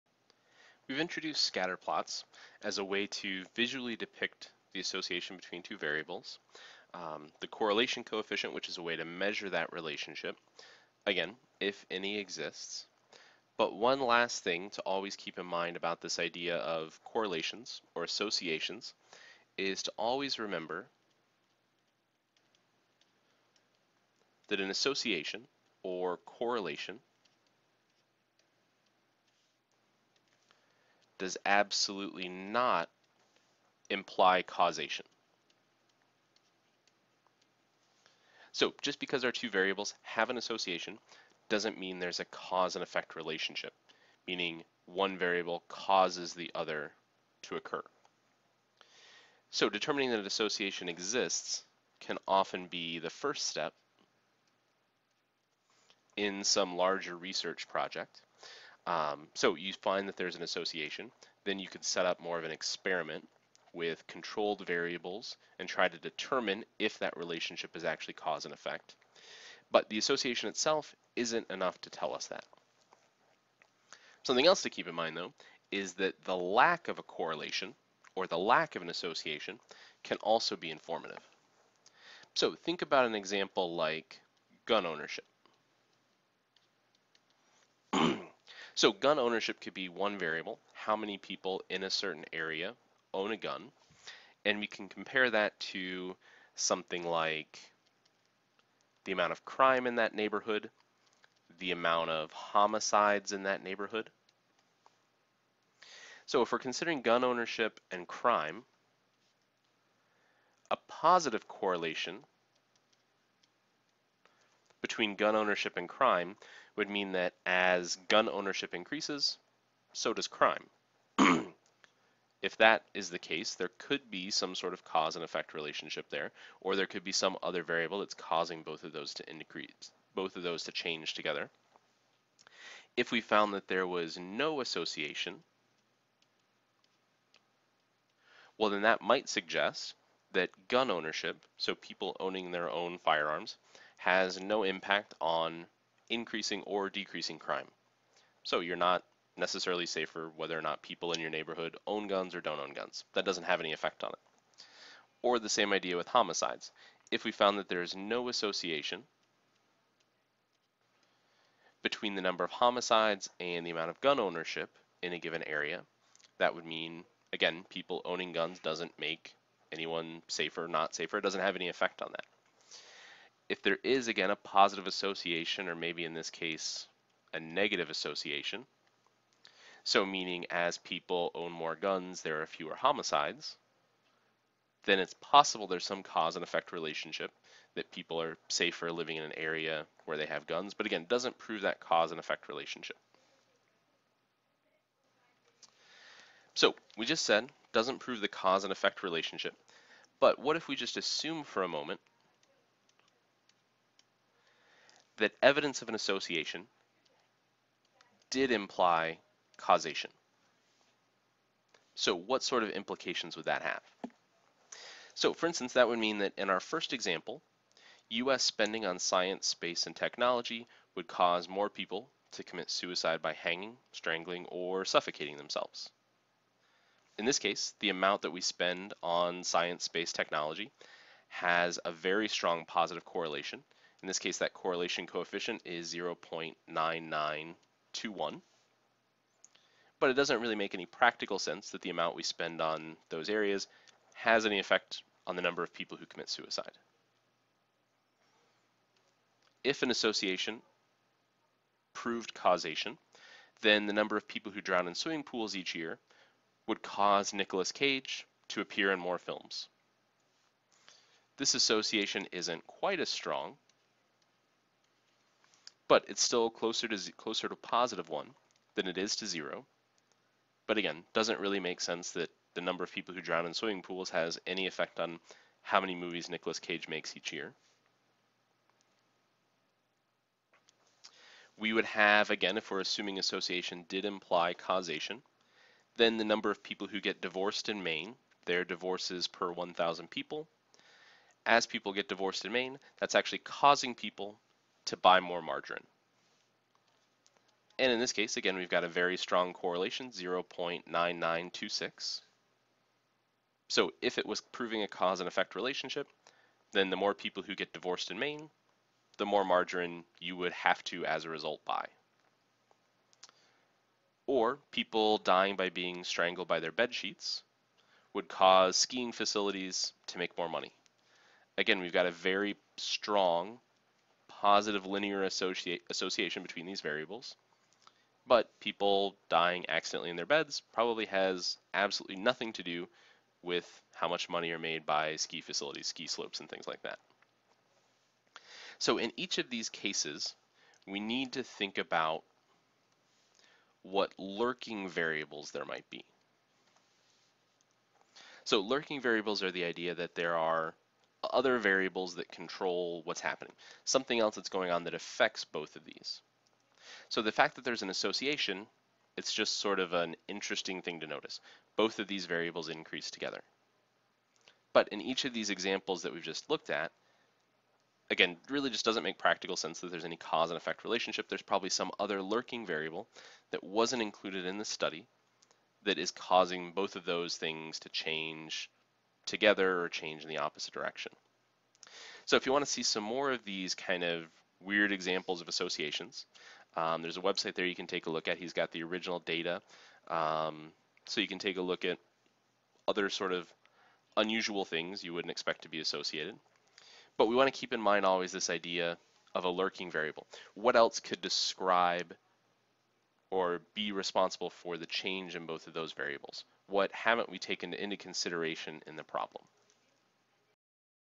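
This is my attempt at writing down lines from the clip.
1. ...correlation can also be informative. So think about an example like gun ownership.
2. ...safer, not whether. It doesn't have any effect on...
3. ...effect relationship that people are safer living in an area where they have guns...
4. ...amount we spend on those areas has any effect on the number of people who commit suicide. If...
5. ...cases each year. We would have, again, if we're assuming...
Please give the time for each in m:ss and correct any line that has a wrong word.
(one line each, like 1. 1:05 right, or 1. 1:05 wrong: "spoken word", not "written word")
1. 1:18 wrong: "association", not "correlation"
2. 2:50 wrong: "safer", not "whether"
3. 3:06 right
4. 4:01 right
5. 4:36 wrong: "makes", not "cases".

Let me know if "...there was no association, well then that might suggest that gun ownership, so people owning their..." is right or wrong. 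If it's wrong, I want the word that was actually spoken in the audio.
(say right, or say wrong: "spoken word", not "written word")
right.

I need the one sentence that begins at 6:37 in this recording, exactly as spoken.
But we want to keep in mind always this idea of a lurking variable.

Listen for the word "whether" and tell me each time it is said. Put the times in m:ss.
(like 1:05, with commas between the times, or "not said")
2:30.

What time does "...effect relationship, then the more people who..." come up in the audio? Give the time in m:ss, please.
5:05.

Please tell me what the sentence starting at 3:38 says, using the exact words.
spending on science, space, and technology would cause more people to commit suicide by hanging, strangling, or suffocating themselves.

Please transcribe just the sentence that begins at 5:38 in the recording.
So in each of these cases, we need to think about what lurking variables there might be.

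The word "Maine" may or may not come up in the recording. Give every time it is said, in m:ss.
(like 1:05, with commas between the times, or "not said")
4:47, 4:52, 5:08.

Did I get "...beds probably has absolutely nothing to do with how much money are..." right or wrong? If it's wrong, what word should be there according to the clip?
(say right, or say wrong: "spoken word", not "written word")
right.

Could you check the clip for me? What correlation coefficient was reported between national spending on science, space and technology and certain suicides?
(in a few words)
0.9921.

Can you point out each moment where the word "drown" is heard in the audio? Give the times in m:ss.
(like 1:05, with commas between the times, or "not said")
4:14, 4:33.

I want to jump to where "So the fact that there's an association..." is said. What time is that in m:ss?
5:57.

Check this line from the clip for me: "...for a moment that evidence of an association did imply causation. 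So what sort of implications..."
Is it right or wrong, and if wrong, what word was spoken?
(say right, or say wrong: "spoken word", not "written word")
right.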